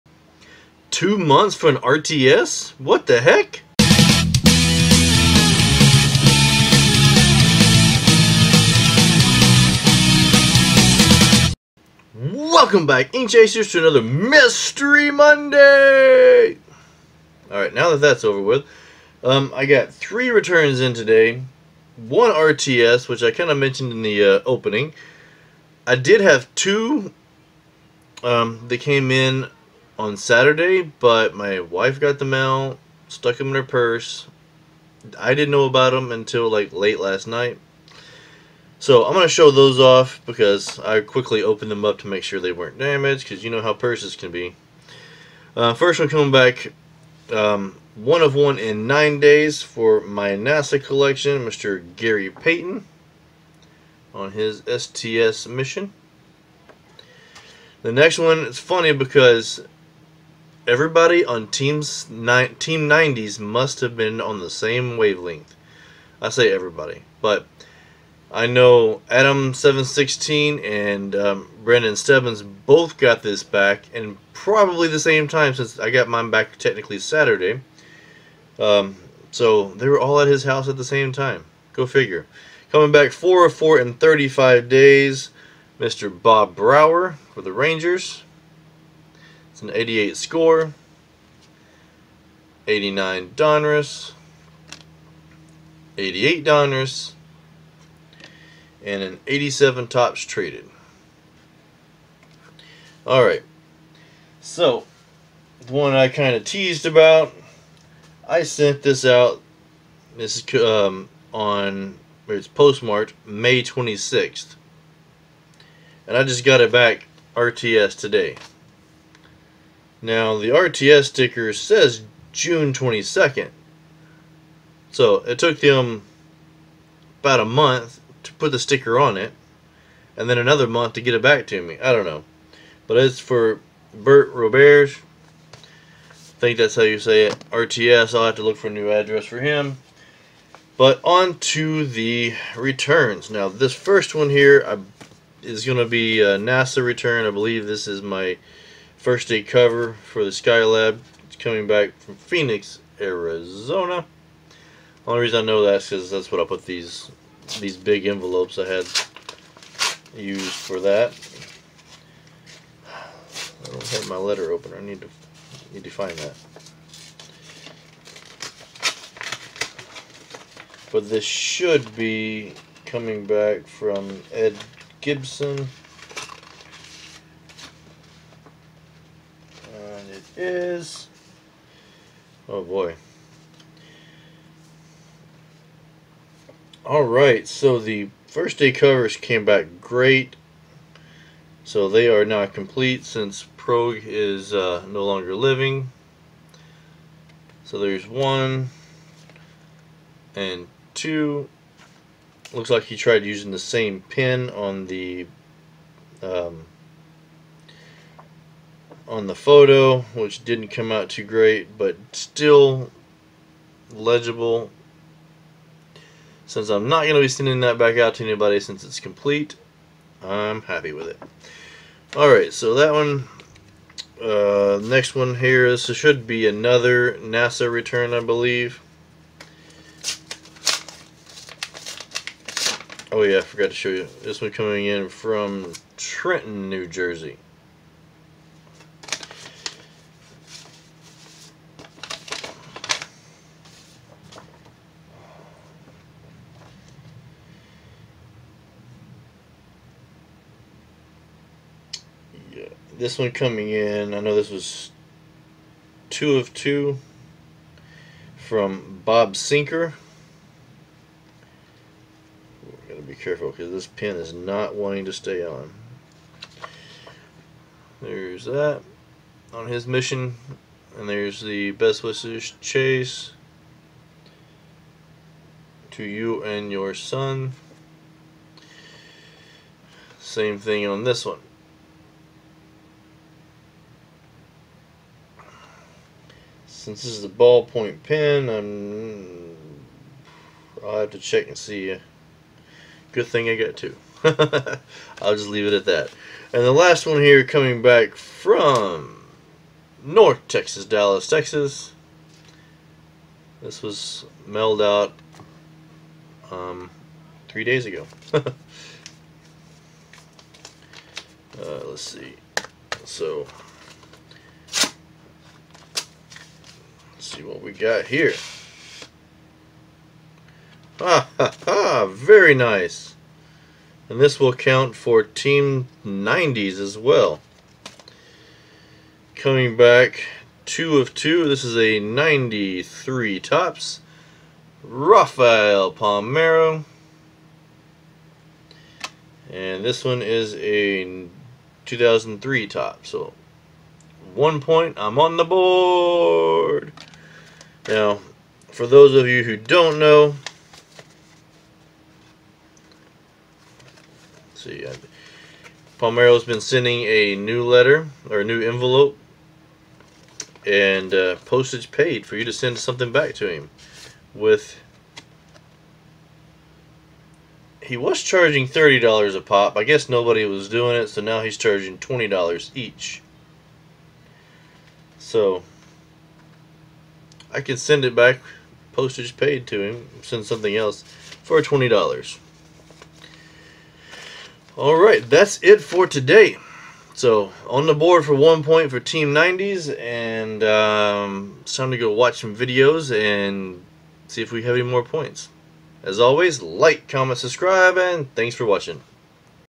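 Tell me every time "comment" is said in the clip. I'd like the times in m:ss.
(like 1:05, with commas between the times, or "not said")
6:37.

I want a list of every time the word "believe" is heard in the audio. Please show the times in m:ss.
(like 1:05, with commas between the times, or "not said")
2:27, 3:48.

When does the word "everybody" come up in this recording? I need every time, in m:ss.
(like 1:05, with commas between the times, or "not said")
1:00, 1:06.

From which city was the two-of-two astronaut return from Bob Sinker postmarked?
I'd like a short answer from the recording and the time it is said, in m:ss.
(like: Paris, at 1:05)
Trenton, New Jersey, at 3:55.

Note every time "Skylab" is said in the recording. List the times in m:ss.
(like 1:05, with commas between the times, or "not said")
2:30.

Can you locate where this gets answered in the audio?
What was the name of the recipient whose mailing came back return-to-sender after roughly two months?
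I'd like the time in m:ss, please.
2:13.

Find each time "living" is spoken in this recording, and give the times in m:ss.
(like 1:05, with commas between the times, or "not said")
3:15.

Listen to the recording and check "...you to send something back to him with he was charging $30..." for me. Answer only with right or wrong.
right.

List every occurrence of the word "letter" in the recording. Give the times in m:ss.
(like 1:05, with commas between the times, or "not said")
2:44, 5:57.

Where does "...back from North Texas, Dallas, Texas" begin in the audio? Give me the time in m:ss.
4:57.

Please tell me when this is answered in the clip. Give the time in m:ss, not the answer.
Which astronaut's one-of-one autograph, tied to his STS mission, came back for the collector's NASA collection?
0:51.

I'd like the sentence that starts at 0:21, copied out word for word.
One RTS, which I kind of mentioned in the uh, opening.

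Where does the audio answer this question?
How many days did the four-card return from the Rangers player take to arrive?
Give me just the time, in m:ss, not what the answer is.
1:23.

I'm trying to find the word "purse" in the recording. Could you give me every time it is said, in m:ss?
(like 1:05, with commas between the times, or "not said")
0:33, 0:43.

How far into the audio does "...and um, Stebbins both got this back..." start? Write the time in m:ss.
1:10.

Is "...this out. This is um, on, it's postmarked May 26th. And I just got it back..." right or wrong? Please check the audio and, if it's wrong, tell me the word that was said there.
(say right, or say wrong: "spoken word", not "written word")
right.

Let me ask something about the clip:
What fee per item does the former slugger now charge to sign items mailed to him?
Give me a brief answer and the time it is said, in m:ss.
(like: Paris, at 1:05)
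$20, at 6:11.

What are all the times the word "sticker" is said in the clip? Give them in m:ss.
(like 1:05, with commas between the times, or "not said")
2:01, 2:08.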